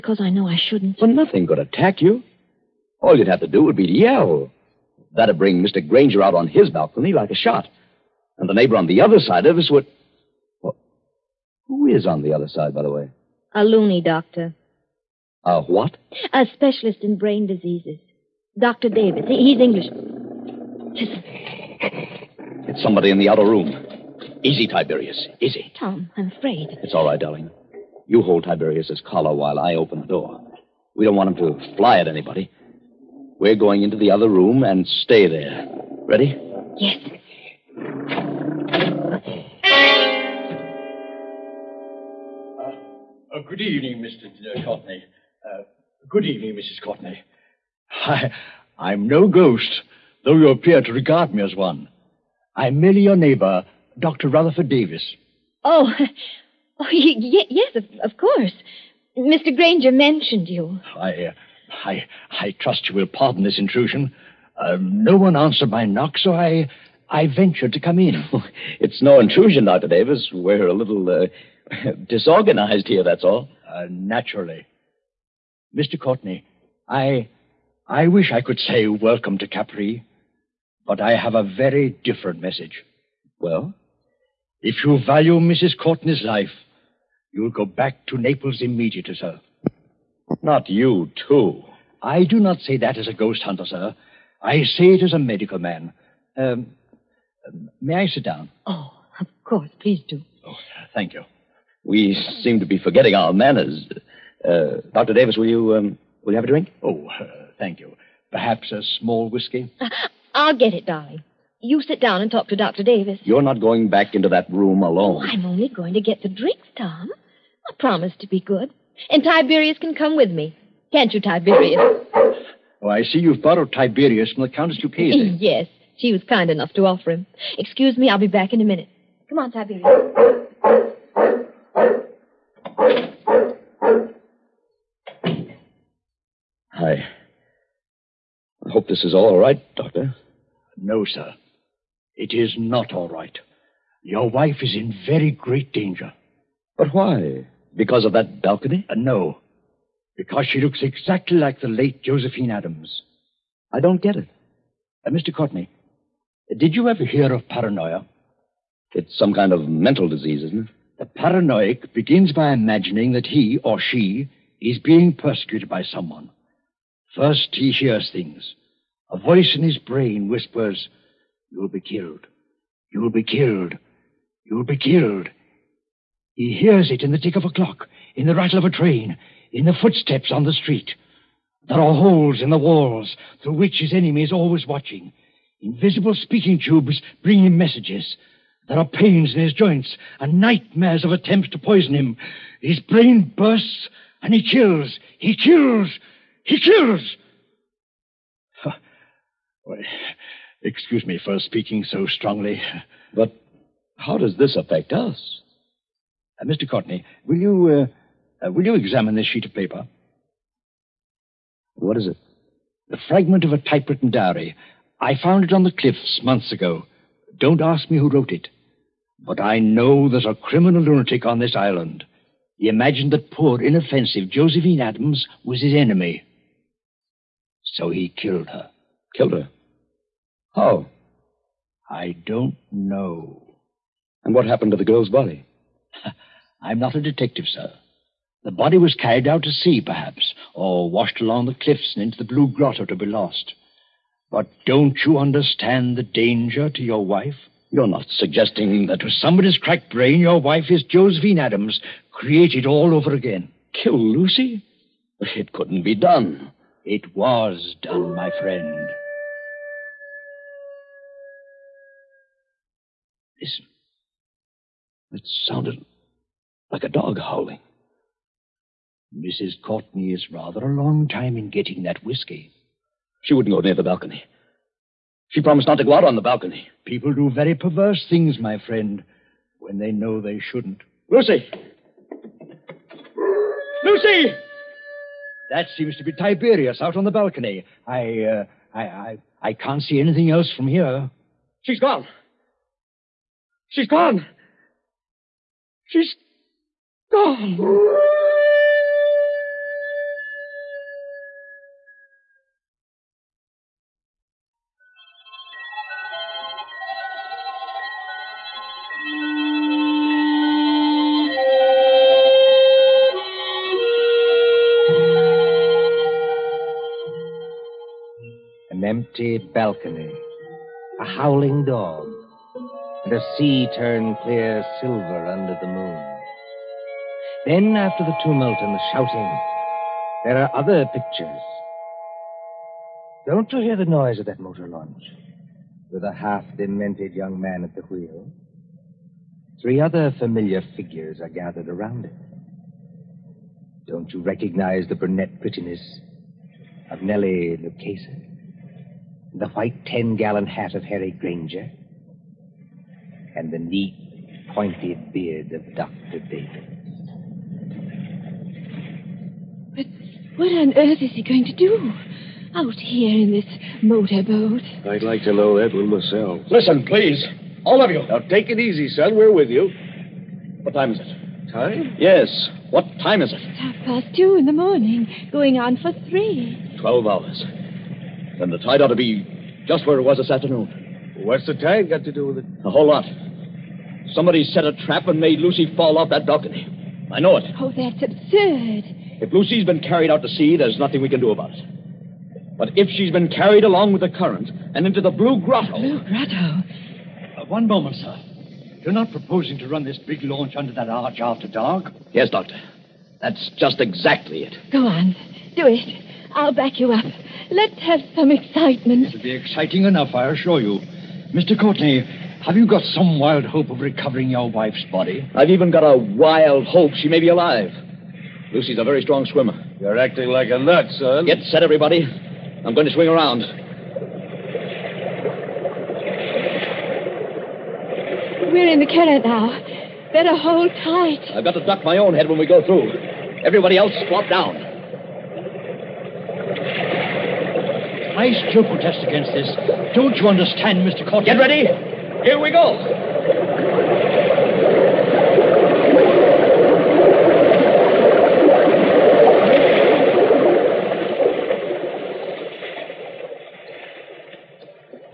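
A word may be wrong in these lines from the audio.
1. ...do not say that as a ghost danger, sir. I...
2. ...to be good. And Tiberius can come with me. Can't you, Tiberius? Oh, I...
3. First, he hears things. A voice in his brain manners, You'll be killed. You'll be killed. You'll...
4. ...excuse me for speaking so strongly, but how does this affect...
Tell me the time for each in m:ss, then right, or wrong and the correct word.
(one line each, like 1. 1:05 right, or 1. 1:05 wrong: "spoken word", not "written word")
1. 1:32 wrong: "hunter", not "danger"
2. 1:58 right
3. 2:47 wrong: "whispers", not "manners"
4. 3:20 right.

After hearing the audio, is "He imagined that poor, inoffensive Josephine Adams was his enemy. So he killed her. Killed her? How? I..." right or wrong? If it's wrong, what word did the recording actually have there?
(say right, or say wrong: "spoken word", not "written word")
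right.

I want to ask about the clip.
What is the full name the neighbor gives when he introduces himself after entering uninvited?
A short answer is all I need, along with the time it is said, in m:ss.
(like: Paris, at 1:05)
Dr. Rutherford Davis, at 0:53.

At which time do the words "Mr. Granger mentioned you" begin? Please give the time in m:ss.
0:59.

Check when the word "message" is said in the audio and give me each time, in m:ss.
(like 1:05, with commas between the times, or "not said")
1:22, 3:07.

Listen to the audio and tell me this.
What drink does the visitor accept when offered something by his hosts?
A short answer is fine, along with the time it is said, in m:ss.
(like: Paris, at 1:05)
A small whiskey, at 1:48.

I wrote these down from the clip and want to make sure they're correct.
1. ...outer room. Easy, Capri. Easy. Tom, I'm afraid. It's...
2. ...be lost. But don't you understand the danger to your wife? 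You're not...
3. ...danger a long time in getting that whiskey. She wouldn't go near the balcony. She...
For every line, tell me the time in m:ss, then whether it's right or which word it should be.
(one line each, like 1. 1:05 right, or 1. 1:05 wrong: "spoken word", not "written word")
1. 0:23 wrong: "Tiberius", not "Capri"
2. 4:02 right
3. 4:30 wrong: "rather", not "danger".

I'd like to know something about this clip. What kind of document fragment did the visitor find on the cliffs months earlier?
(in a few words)
A typewritten diary.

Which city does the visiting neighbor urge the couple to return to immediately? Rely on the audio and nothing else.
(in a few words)
Naples.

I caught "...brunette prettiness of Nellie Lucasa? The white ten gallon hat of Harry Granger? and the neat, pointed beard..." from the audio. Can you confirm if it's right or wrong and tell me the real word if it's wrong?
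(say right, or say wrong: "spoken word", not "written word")
right.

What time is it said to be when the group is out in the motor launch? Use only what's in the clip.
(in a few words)
Half past two.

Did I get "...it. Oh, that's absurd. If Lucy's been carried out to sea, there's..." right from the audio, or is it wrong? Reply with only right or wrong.
right.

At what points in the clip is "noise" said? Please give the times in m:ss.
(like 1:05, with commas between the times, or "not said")
5:33.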